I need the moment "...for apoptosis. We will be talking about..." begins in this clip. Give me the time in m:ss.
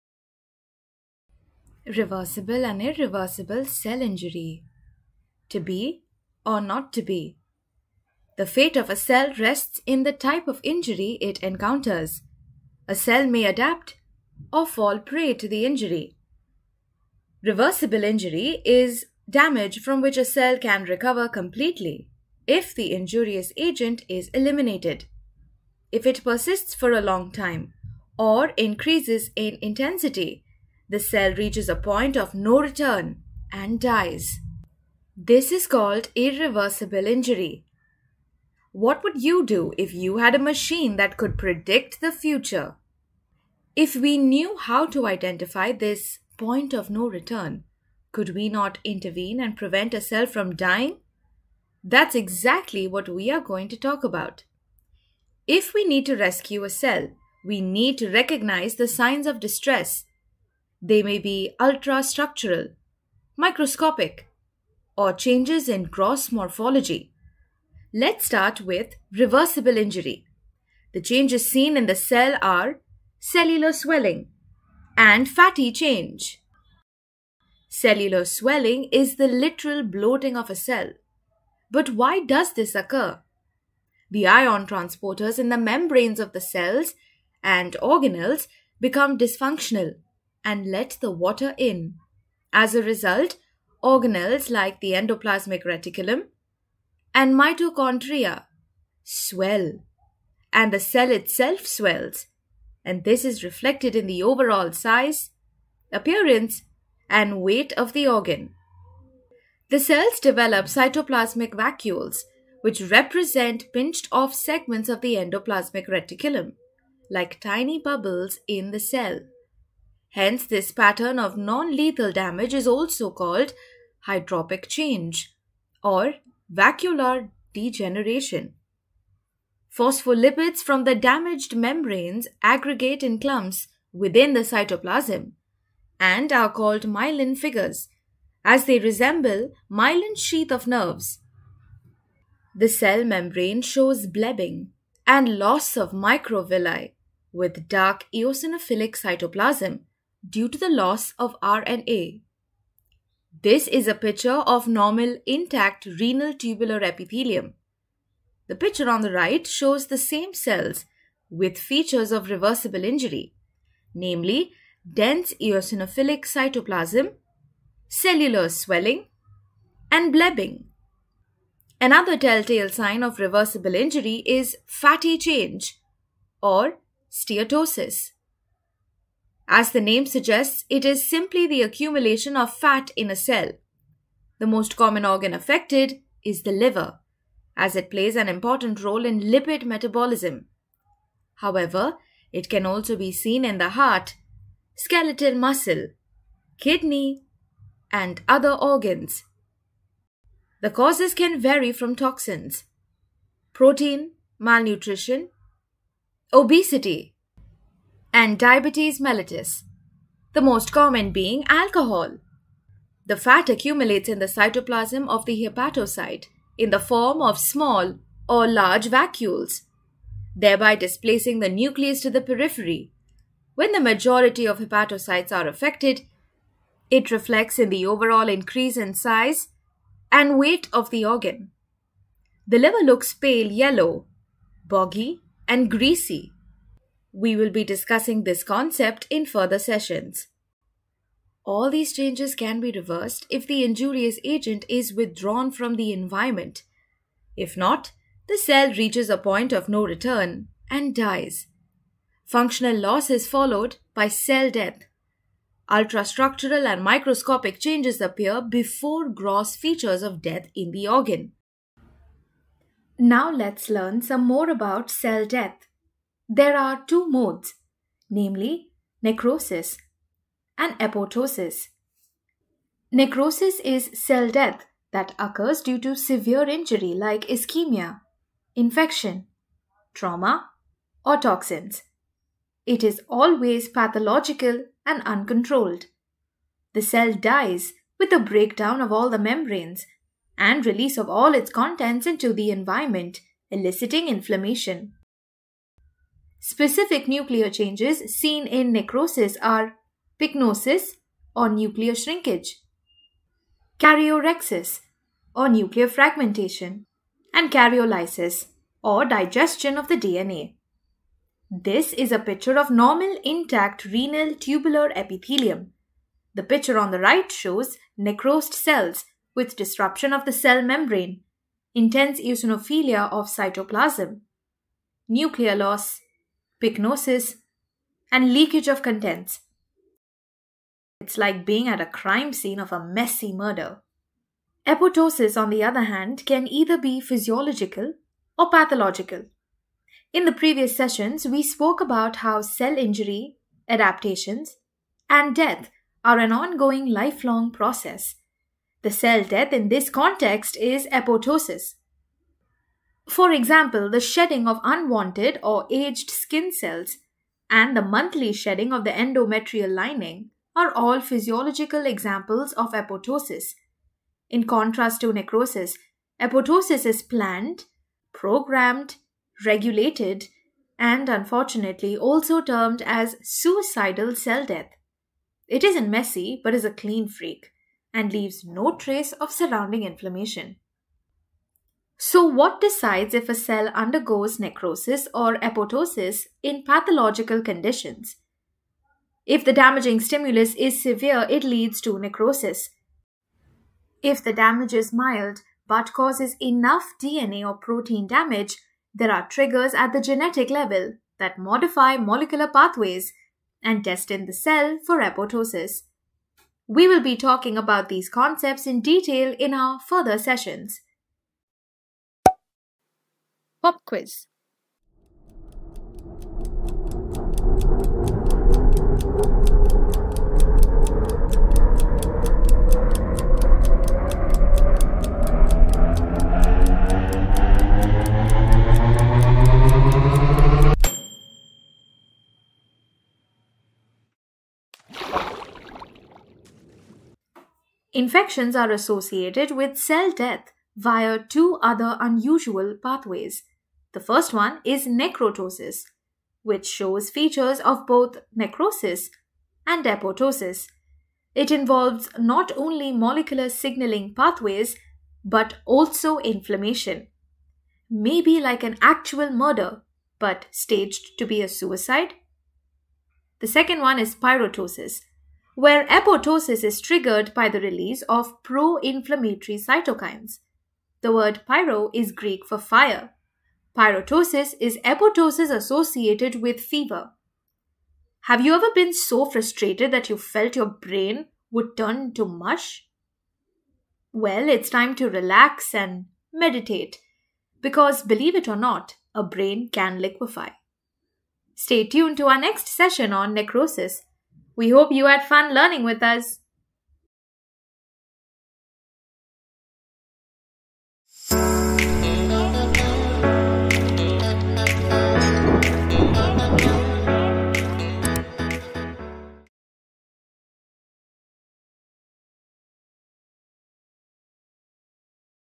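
6:44.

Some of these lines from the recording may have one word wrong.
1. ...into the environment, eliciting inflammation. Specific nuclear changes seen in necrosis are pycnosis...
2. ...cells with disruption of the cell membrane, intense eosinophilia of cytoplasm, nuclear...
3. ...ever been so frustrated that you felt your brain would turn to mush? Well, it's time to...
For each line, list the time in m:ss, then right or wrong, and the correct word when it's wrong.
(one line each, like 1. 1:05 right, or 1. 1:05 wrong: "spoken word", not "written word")
1. 4:52 right
2. 5:18 right
3. 7:58 right.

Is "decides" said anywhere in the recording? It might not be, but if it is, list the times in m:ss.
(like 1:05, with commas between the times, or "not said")
6:22.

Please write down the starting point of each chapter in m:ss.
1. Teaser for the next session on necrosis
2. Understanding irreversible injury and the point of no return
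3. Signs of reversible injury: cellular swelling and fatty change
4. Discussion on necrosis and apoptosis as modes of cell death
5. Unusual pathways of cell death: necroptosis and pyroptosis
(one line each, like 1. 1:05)
1. 8:09
2. 3:43
3. 0:51
4. 4:48
5. 6:52.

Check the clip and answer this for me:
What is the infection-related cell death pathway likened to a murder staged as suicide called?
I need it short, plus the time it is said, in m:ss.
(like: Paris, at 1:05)
necroptosis, at 7:24.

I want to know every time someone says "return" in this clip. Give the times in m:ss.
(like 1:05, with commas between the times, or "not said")
0:32, 0:47, 4:09.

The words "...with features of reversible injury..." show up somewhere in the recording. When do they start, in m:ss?
2:41.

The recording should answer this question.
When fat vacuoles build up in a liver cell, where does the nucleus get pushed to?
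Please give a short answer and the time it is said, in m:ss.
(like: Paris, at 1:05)
the periphery, at 3:42.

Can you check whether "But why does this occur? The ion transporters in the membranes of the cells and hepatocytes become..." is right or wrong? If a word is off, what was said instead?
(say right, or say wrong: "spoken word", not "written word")
wrong: "organelles", not "hepatocytes".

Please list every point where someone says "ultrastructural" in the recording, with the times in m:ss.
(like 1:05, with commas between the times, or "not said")
1:01, 4:15.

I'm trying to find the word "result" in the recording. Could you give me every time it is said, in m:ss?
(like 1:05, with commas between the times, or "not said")
1:32.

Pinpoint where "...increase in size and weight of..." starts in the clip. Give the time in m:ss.
3:48.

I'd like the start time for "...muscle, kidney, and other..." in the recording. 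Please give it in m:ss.
3:15.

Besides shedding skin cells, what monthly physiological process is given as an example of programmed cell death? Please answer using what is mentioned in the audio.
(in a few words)
shedding of the endometrial lining.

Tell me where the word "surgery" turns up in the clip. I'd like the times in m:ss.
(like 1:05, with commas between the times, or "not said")
not said.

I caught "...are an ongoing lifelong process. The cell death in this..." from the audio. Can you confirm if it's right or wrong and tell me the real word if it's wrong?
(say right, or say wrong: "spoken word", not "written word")
right.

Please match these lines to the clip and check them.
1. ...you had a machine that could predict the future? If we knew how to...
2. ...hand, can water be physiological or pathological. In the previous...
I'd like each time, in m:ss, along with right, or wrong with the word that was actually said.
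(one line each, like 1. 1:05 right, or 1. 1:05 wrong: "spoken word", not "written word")
1. 0:39 right
2. 5:35 wrong: "either", not "water".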